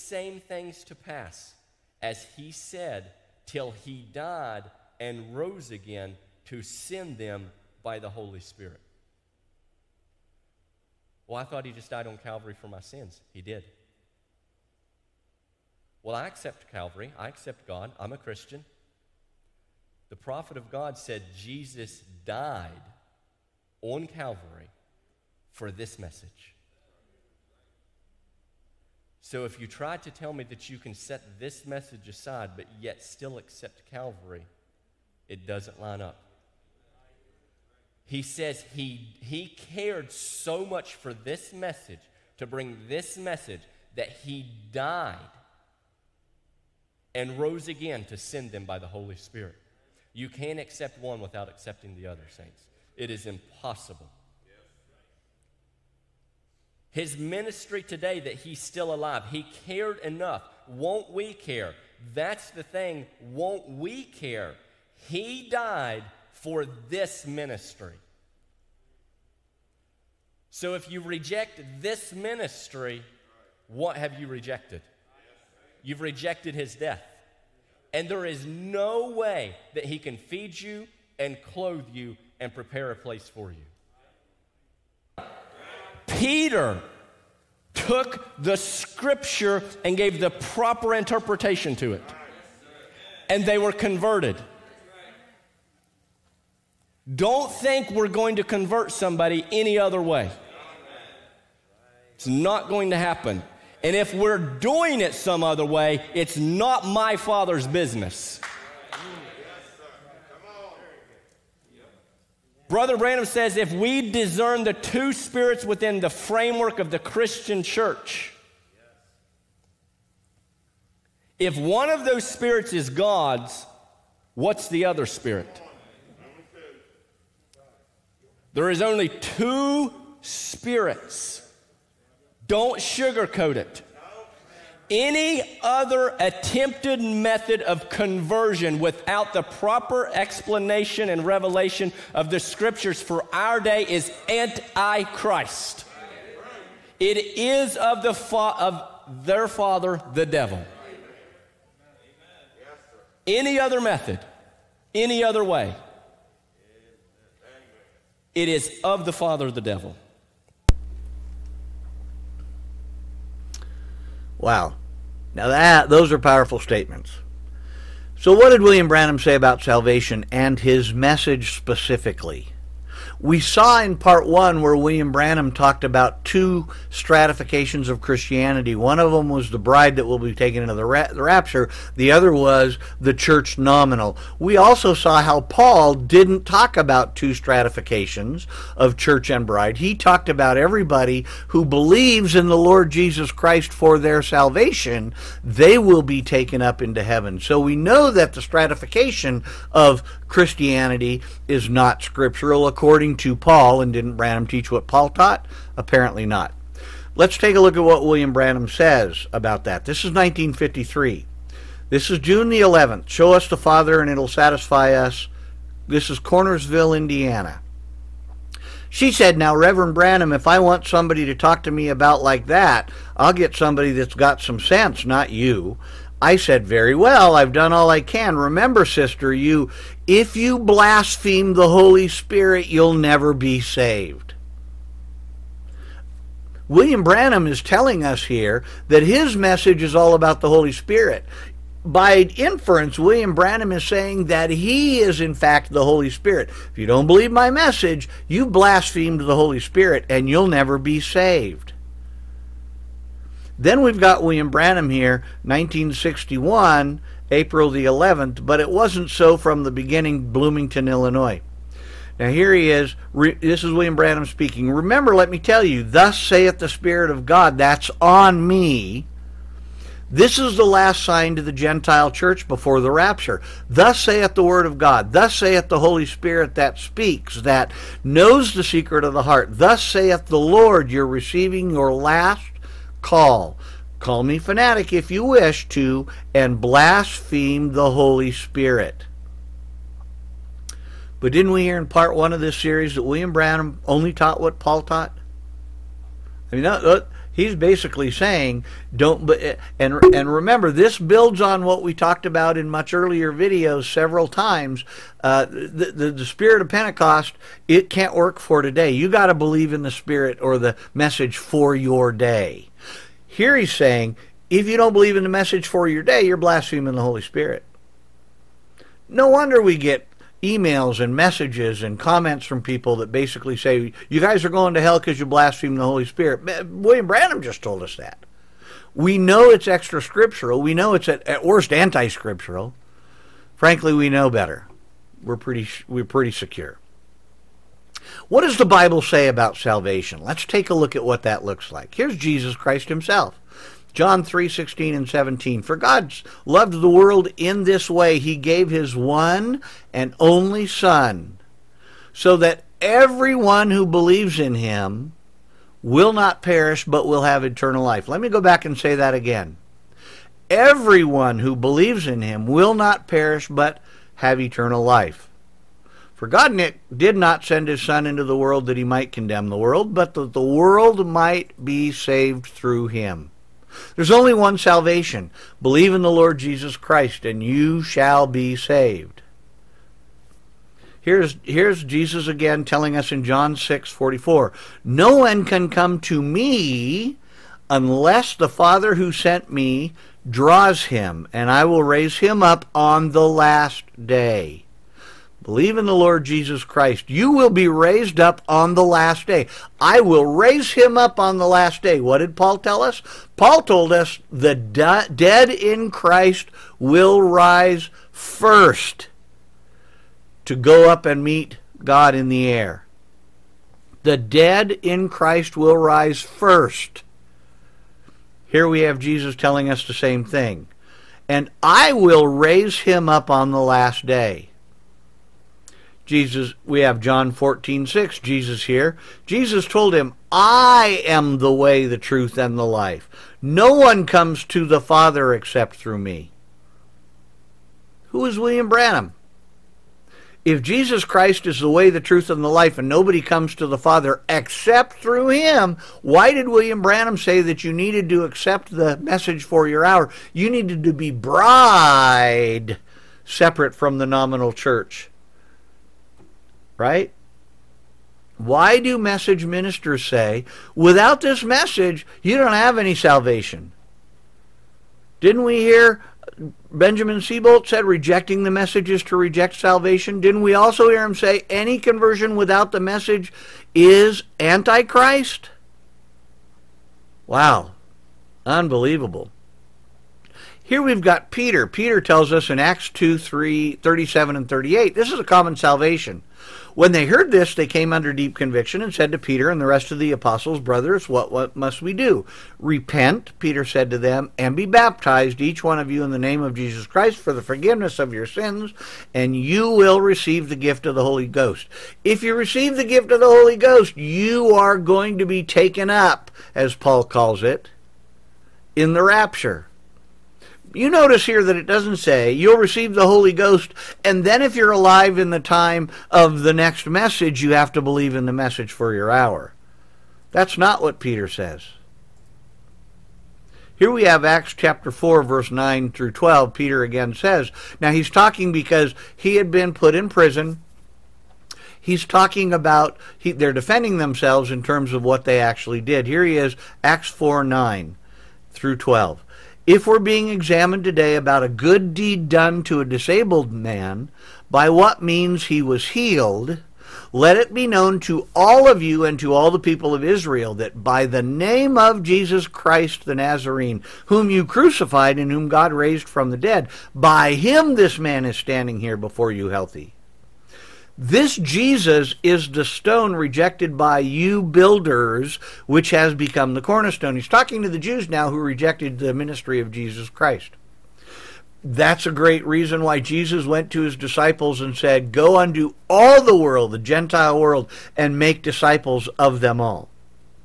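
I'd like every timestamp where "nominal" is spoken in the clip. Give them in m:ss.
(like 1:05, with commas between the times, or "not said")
3:03, 7:34.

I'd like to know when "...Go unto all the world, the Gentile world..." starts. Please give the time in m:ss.
9:35.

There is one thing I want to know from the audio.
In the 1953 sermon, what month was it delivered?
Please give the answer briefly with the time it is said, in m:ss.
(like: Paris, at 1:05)
June, at 3:32.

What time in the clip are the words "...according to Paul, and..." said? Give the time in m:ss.
3:22.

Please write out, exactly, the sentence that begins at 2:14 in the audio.
Any other attempted method of conversion without the proper explanation and revelation of the scriptures for our day is antichrist.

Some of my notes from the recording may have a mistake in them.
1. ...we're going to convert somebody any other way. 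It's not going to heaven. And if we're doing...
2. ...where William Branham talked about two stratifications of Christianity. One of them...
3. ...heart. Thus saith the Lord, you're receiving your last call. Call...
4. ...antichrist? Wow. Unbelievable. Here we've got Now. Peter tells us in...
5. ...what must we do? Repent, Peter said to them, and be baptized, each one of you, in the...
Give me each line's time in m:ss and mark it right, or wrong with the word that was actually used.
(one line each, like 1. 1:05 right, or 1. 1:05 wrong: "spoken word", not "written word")
1. 1:37 wrong: "happen", not "heaven"
2. 2:54 right
3. 4:39 right
4. 7:54 wrong: "Peter", not "Now"
5. 8:11 right.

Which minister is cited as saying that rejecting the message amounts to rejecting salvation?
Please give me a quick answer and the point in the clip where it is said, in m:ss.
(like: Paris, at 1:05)
Benjamin Seabolt, at 7:46.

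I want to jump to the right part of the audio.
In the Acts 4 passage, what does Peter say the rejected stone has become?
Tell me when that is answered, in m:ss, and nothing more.
9:26.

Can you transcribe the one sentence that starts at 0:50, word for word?
You can't accept one without accepting the other, saints.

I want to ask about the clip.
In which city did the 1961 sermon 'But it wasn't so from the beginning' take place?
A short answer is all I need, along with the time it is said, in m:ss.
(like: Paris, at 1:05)
Bloomington, Illinois, at 4:20.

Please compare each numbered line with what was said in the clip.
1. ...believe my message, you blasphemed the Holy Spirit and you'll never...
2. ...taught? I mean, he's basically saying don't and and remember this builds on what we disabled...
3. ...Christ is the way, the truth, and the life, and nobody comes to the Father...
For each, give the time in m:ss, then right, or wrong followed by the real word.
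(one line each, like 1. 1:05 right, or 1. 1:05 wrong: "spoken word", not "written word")
1. 4:07 right
2. 4:54 wrong: "talked", not "disabled"
3. 7:21 right.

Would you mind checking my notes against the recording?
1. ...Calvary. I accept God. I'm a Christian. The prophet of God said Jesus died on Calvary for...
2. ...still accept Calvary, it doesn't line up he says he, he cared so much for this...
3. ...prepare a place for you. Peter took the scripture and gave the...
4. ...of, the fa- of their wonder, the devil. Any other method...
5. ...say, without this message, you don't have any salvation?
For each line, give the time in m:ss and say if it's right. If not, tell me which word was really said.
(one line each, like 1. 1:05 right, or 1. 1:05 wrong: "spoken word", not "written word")
1. 0:16 right
2. 0:33 right
3. 1:22 right
4. 2:27 wrong: "father", not "wonder"
5. 7:40 right.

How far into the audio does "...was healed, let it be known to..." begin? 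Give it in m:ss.
9:05.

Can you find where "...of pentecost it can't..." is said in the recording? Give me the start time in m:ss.
5:06.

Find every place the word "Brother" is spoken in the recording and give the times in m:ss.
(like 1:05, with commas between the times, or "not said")
1:52, 8:10.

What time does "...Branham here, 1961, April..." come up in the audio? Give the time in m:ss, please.
4:14.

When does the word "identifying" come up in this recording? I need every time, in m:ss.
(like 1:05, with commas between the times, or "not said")
not said.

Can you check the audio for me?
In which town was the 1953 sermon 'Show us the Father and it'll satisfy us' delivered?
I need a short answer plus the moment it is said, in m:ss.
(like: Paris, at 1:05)
Connersville, Indiana, at 3:36.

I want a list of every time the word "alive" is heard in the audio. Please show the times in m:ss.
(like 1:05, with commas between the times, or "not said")
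0:58, 8:34.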